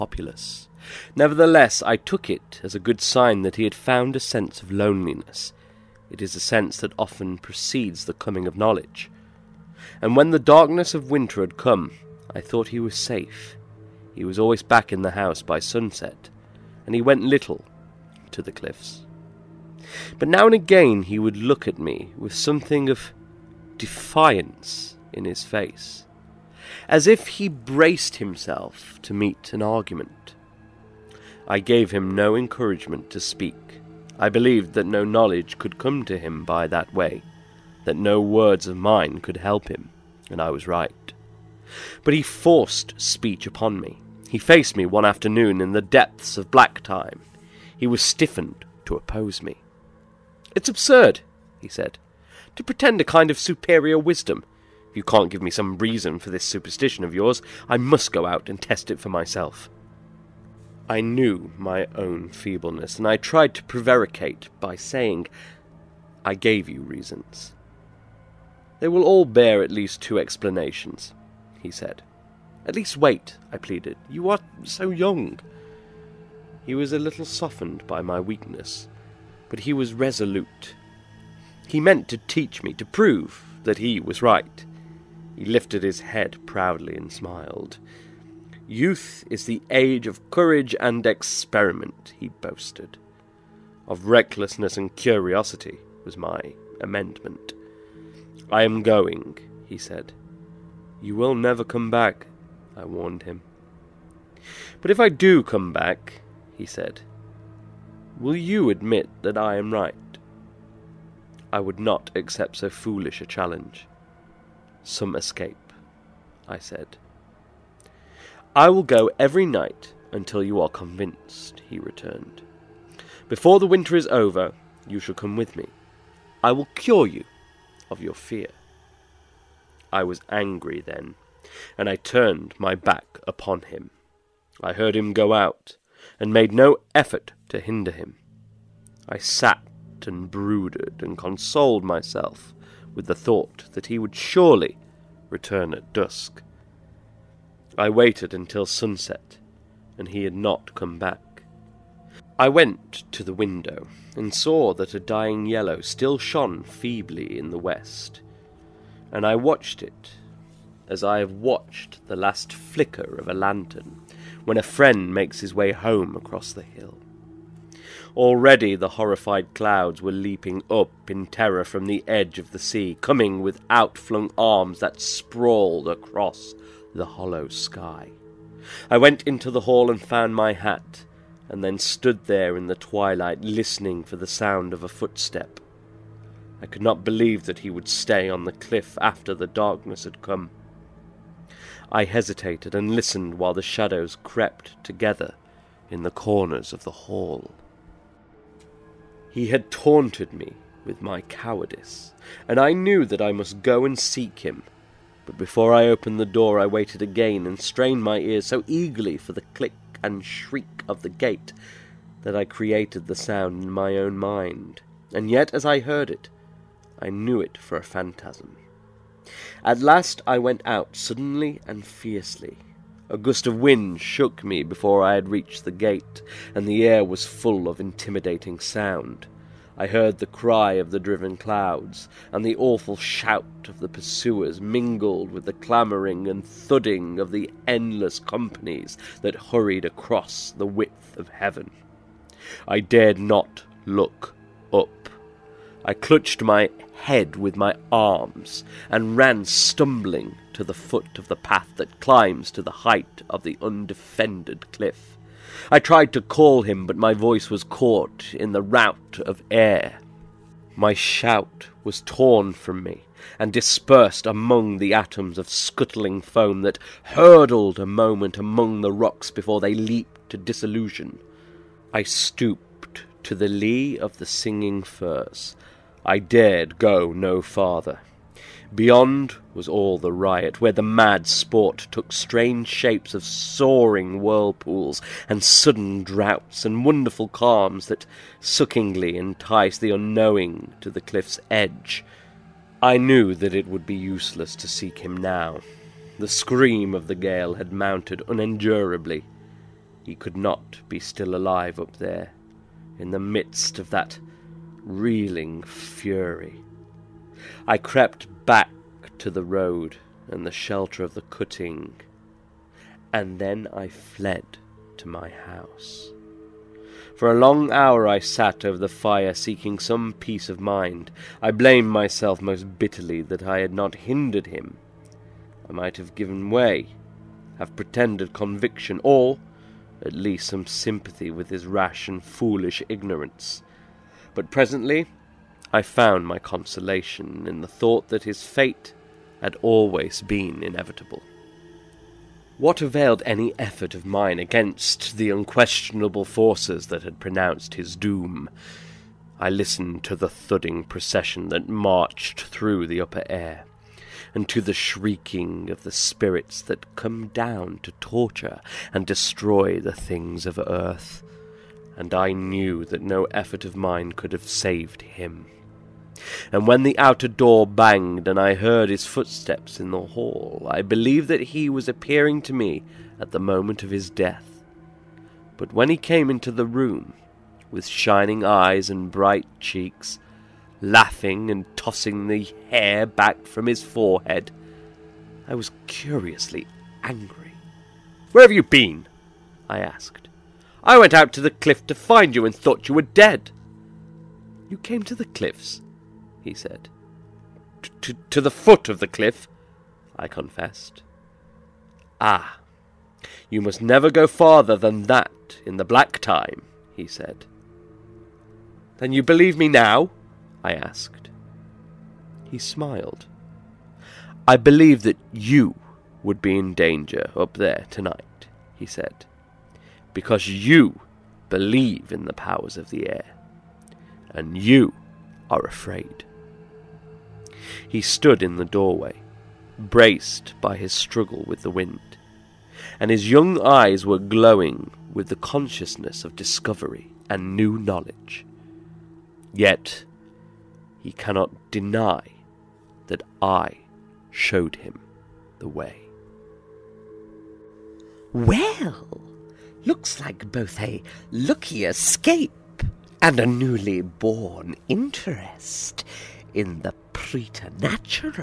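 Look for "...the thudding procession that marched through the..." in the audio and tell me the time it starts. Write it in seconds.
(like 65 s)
350 s.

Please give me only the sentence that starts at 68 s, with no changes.
They will all bear at least two explanations, he said.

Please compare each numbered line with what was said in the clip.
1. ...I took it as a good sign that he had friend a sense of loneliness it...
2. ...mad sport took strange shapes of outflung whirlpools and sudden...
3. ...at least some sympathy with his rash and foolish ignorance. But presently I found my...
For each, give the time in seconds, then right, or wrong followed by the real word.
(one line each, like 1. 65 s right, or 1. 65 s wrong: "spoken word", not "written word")
1. 1 s wrong: "found", not "friend"
2. 280 s wrong: "soaring", not "outflung"
3. 330 s right.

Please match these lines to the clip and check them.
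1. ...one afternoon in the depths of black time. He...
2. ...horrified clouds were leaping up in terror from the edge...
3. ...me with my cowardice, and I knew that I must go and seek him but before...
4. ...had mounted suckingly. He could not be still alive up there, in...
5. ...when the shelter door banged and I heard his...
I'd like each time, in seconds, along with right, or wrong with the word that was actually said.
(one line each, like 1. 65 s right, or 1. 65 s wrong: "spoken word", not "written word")
1. 44 s right
2. 168 s right
3. 200 s right
4. 297 s wrong: "unendurably", not "suckingly"
5. 366 s wrong: "outer", not "shelter".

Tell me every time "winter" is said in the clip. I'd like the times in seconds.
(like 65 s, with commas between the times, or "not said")
11 s, 123 s.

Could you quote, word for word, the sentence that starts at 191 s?
I hesitated and listened while the shadows crept together in the corners of the hall.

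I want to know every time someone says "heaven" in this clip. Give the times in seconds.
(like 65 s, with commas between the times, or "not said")
241 s.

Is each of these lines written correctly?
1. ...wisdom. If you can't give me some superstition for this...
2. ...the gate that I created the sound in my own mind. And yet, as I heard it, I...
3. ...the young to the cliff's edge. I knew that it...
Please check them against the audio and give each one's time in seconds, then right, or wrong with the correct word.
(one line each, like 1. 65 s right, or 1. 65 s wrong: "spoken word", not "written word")
1. 53 s wrong: "reason", not "superstition"
2. 211 s right
3. 289 s wrong: "unknowing", not "young".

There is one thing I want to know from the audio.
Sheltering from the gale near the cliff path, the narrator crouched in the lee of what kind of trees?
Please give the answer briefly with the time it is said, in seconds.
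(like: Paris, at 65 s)
firs, at 274 s.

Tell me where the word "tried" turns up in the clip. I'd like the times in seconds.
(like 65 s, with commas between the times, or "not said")
63 s, 255 s.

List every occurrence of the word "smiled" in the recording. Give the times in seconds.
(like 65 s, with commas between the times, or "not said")
87 s, 412 s.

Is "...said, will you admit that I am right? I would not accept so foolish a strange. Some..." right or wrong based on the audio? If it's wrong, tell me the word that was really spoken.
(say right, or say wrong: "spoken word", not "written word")
wrong: "challenge", not "strange".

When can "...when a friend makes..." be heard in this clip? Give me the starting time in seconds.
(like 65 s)
164 s.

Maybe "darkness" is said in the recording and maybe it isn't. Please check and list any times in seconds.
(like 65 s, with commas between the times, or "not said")
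10 s, 189 s.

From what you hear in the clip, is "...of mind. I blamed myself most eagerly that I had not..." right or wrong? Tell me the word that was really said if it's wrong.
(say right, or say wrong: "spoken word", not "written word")
wrong: "bitterly", not "eagerly".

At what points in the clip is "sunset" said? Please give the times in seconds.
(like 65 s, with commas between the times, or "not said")
15 s, 148 s.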